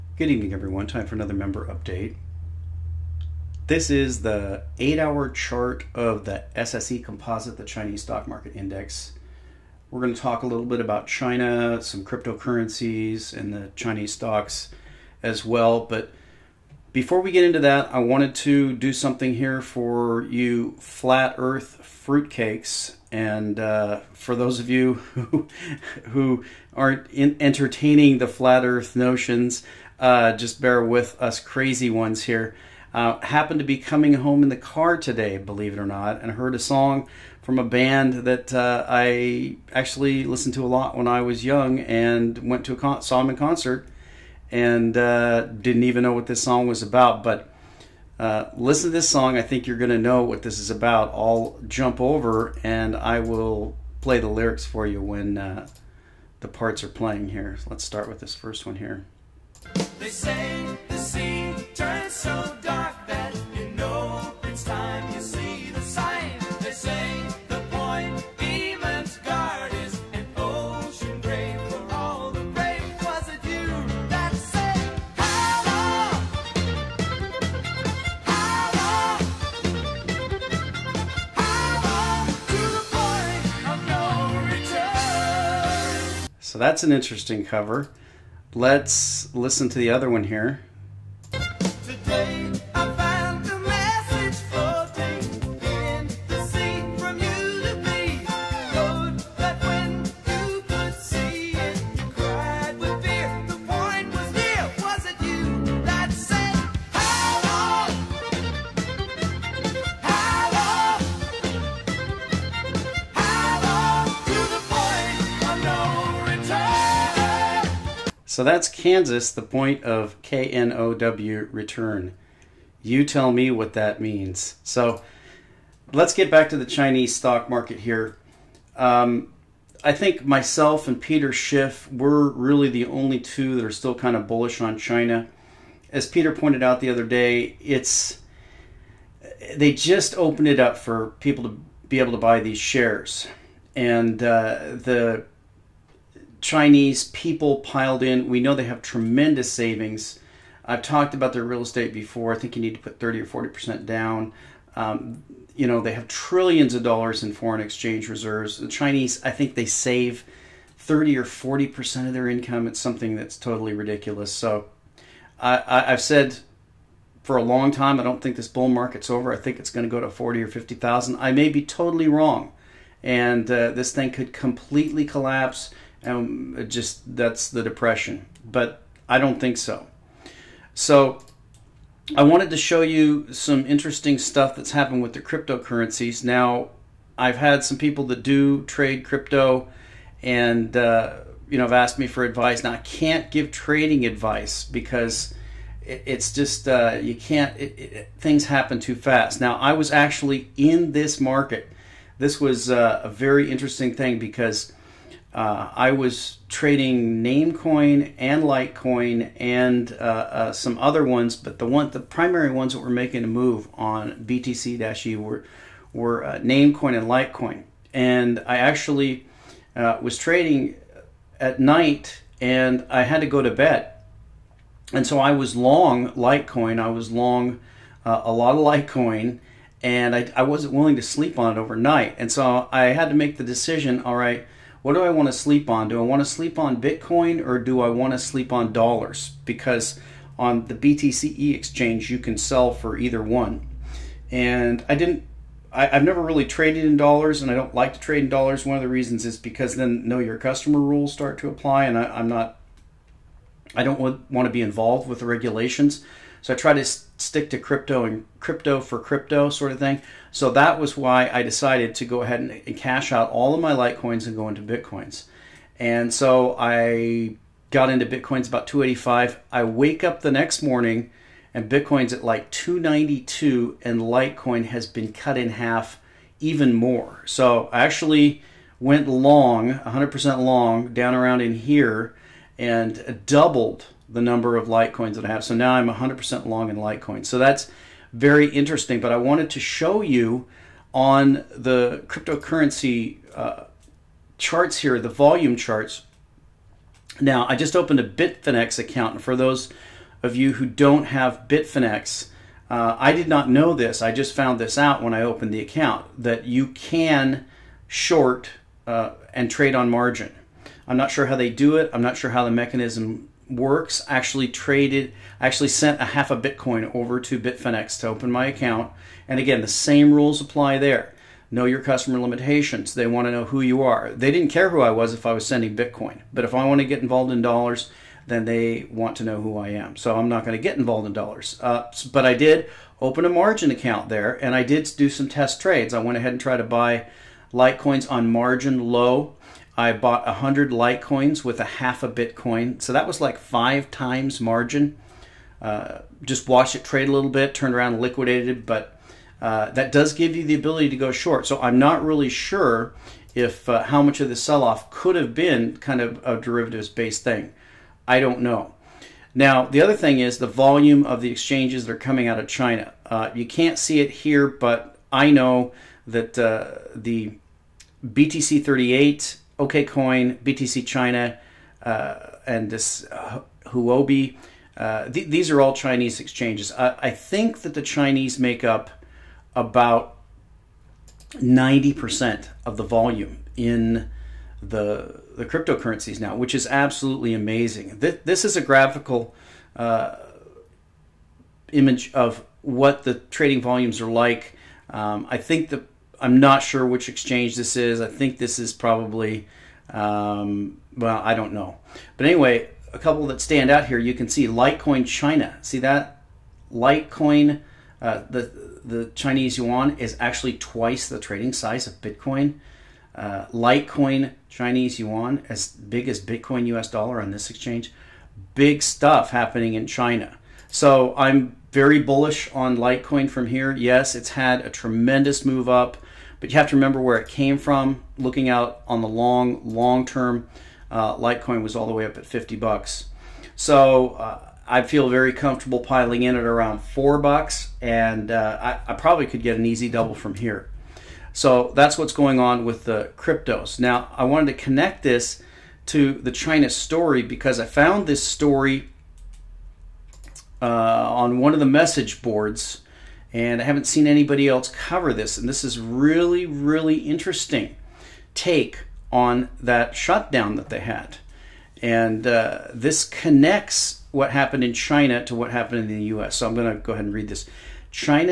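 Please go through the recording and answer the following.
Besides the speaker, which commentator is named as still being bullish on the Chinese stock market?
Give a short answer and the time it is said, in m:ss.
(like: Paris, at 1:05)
Peter Schiff, at 2:11.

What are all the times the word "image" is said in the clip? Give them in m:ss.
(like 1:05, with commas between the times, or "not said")
6:31.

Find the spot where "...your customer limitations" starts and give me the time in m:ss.
5:21.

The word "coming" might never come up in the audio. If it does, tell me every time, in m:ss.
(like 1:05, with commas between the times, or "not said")
0:33, 6:01.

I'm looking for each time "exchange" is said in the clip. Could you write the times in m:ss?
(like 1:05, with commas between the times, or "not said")
2:37, 4:01, 6:01, 6:16, 6:37, 6:57.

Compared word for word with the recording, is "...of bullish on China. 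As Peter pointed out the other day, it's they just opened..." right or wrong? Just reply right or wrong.
right.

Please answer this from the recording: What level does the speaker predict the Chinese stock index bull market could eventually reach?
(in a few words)
40 or 50,000.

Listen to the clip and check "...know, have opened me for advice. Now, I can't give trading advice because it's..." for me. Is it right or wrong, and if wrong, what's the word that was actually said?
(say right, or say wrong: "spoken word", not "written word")
wrong: "asked", not "opened".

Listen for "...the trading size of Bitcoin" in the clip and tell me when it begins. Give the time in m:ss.
6:51.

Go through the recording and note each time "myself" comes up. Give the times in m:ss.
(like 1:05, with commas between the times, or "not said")
2:10.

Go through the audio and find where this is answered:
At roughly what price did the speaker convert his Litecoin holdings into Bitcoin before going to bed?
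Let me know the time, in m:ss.
4:28.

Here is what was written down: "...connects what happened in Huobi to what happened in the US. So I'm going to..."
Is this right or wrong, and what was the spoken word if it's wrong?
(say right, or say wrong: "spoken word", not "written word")
wrong: "China", not "Huobi".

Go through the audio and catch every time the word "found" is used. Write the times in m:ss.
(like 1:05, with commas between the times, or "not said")
5:04, 7:27.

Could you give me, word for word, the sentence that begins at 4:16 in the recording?
So I try to stick to crypto and crypto for crypto sort of thing.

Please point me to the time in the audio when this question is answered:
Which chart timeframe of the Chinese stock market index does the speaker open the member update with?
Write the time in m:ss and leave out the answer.
0:04.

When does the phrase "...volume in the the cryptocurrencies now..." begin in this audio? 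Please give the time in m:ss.
6:22.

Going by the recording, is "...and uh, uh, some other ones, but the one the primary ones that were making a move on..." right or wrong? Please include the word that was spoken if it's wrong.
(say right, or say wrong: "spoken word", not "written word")
right.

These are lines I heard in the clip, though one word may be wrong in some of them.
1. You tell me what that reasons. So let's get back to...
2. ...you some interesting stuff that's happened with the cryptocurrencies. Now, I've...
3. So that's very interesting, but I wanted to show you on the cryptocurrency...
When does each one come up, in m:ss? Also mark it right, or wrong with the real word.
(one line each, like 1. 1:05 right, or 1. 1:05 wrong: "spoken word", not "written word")
1. 2:02 wrong: "means", not "reasons"
2. 3:02 right
3. 4:47 right.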